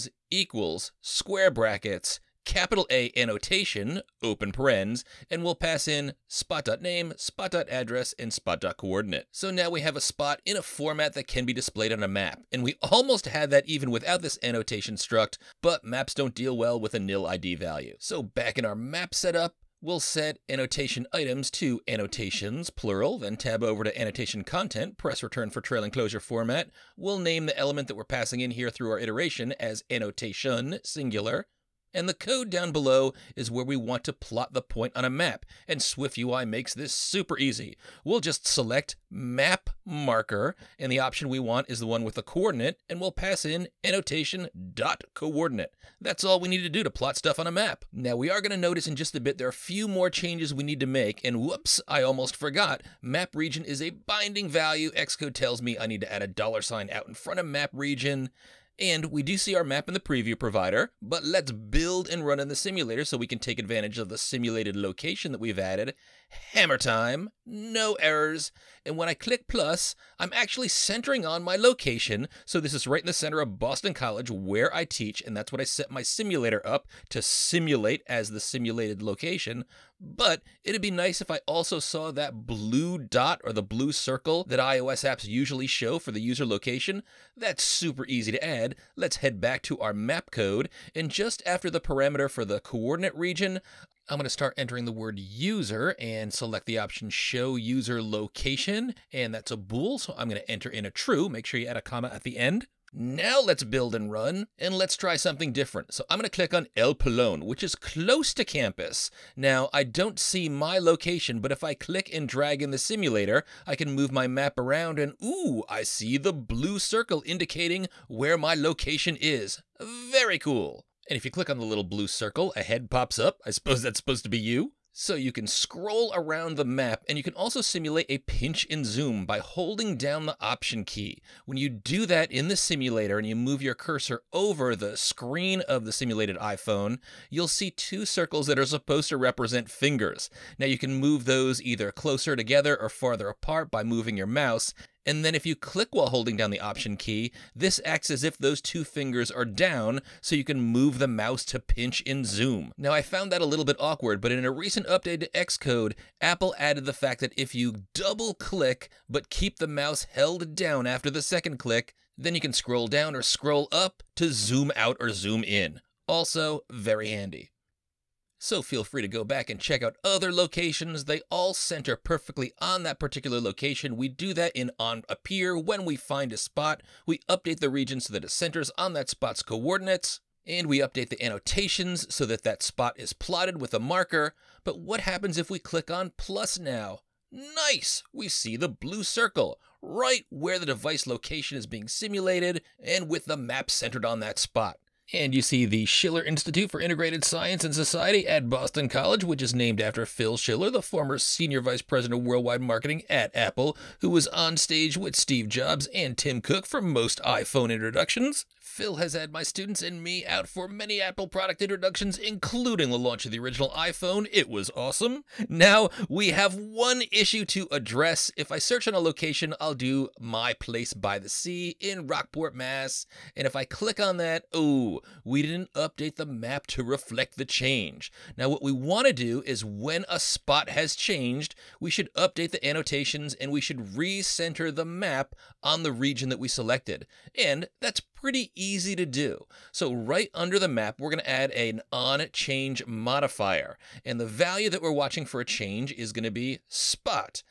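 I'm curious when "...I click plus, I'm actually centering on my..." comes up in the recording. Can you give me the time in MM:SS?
01:09.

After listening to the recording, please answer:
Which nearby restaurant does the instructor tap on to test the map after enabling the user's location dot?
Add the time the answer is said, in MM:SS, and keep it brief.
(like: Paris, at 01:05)
El Pelon, at 01:46.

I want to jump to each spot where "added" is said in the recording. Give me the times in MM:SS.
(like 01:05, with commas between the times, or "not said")
01:05, 02:36.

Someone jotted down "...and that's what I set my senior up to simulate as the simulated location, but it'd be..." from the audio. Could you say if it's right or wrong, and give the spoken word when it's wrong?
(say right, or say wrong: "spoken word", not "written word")
wrong: "simulator", not "senior".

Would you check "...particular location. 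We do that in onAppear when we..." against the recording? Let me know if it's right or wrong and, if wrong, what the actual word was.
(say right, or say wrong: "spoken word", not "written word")
right.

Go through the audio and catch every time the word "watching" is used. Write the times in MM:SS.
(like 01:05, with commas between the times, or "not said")
04:04.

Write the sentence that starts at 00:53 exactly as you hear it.
Map region is a binding value.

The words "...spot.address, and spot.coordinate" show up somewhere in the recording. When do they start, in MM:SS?
00:07.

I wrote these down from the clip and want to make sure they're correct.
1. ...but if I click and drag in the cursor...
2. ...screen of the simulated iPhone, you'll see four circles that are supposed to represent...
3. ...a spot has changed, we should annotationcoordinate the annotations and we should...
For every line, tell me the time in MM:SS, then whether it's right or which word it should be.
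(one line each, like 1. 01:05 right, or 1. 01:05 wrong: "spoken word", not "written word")
1. 01:51 wrong: "simulator", not "cursor"
2. 02:14 wrong: "two", not "four"
3. 03:50 wrong: "update", not "annotationcoordinate".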